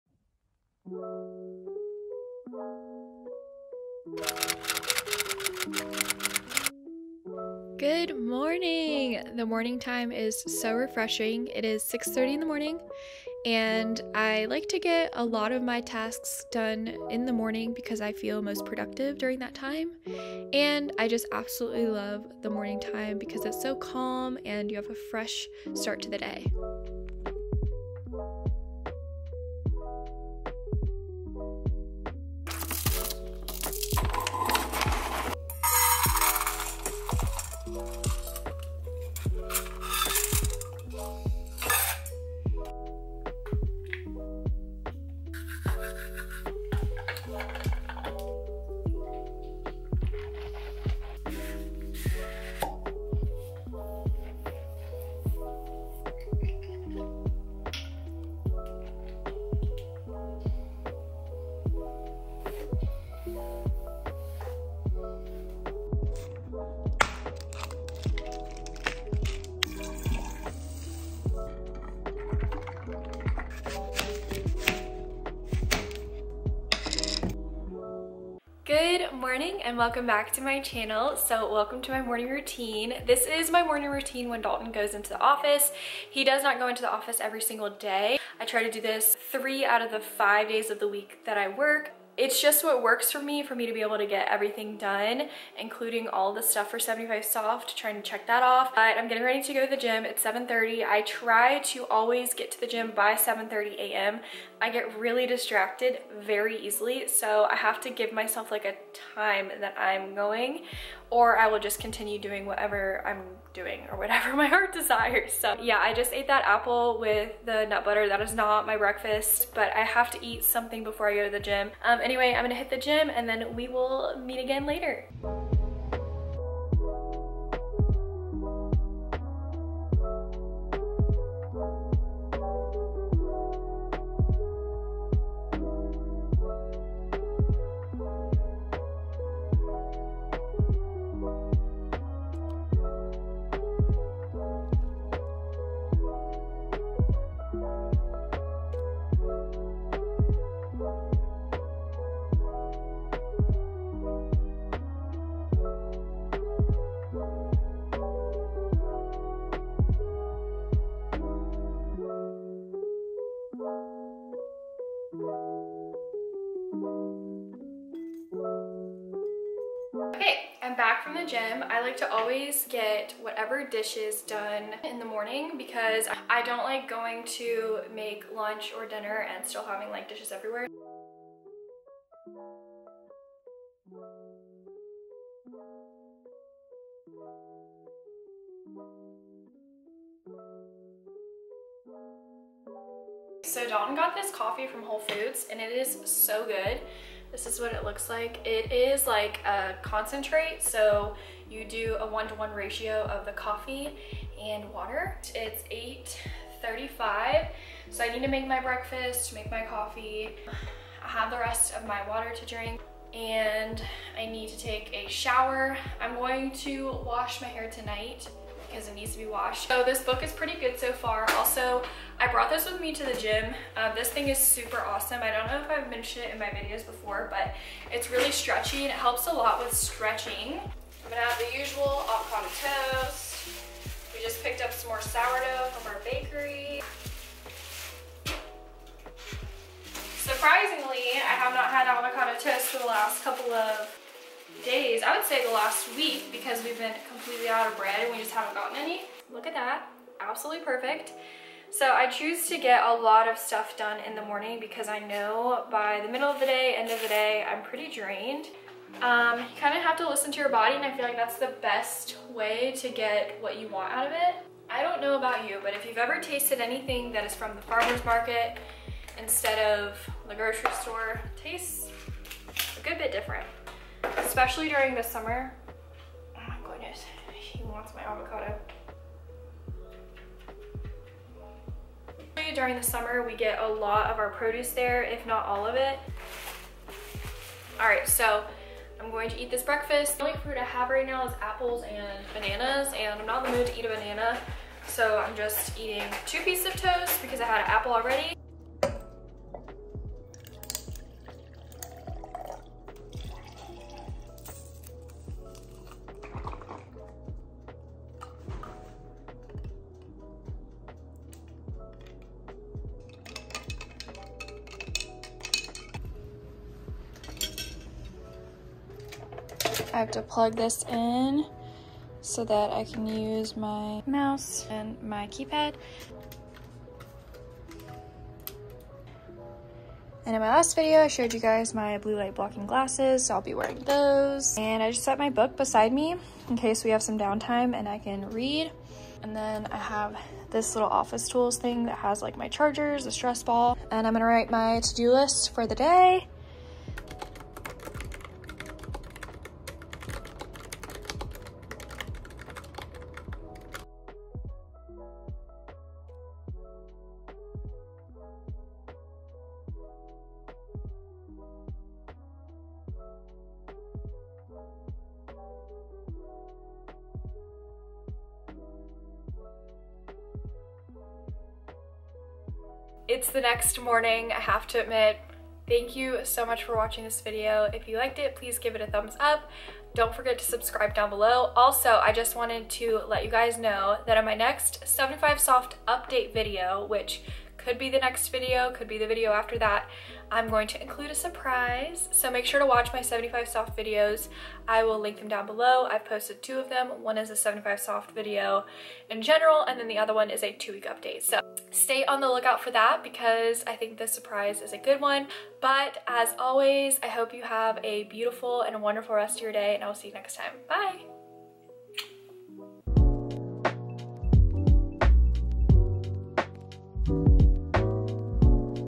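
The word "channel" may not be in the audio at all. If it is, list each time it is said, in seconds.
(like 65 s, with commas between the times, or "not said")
80 s.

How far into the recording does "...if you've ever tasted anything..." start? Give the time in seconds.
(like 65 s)
265 s.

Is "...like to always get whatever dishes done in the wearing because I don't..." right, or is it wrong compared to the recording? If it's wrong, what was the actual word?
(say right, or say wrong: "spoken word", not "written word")
wrong: "morning", not "wearing".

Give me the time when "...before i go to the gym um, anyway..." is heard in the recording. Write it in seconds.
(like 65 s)
120 s.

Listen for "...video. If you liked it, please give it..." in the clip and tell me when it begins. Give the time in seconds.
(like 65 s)
377 s.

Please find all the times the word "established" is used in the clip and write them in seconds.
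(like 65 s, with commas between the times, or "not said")
not said.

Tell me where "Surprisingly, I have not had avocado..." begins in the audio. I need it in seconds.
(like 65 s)
240 s.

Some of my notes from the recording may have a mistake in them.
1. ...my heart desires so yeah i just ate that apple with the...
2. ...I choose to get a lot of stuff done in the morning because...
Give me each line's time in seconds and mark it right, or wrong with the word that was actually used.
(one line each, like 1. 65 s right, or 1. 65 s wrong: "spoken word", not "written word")
1. 114 s right
2. 251 s right.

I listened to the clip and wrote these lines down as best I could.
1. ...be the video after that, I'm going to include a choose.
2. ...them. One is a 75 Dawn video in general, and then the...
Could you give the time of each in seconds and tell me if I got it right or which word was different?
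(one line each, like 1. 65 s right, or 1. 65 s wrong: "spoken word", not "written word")
1. 388 s wrong: "surprise", not "choose"
2. 396 s wrong: "Soft", not "Dawn".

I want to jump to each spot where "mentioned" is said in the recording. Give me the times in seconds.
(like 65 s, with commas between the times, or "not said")
225 s.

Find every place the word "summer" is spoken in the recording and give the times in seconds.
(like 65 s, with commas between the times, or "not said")
275 s, 282 s.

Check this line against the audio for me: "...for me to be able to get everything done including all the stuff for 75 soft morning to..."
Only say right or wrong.
wrong.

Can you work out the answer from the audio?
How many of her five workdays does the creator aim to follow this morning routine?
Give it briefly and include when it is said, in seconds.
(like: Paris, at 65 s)
3, at 89 s.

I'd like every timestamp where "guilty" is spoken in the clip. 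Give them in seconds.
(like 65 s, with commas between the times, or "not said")
not said.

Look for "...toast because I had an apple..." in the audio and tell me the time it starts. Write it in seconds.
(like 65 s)
296 s.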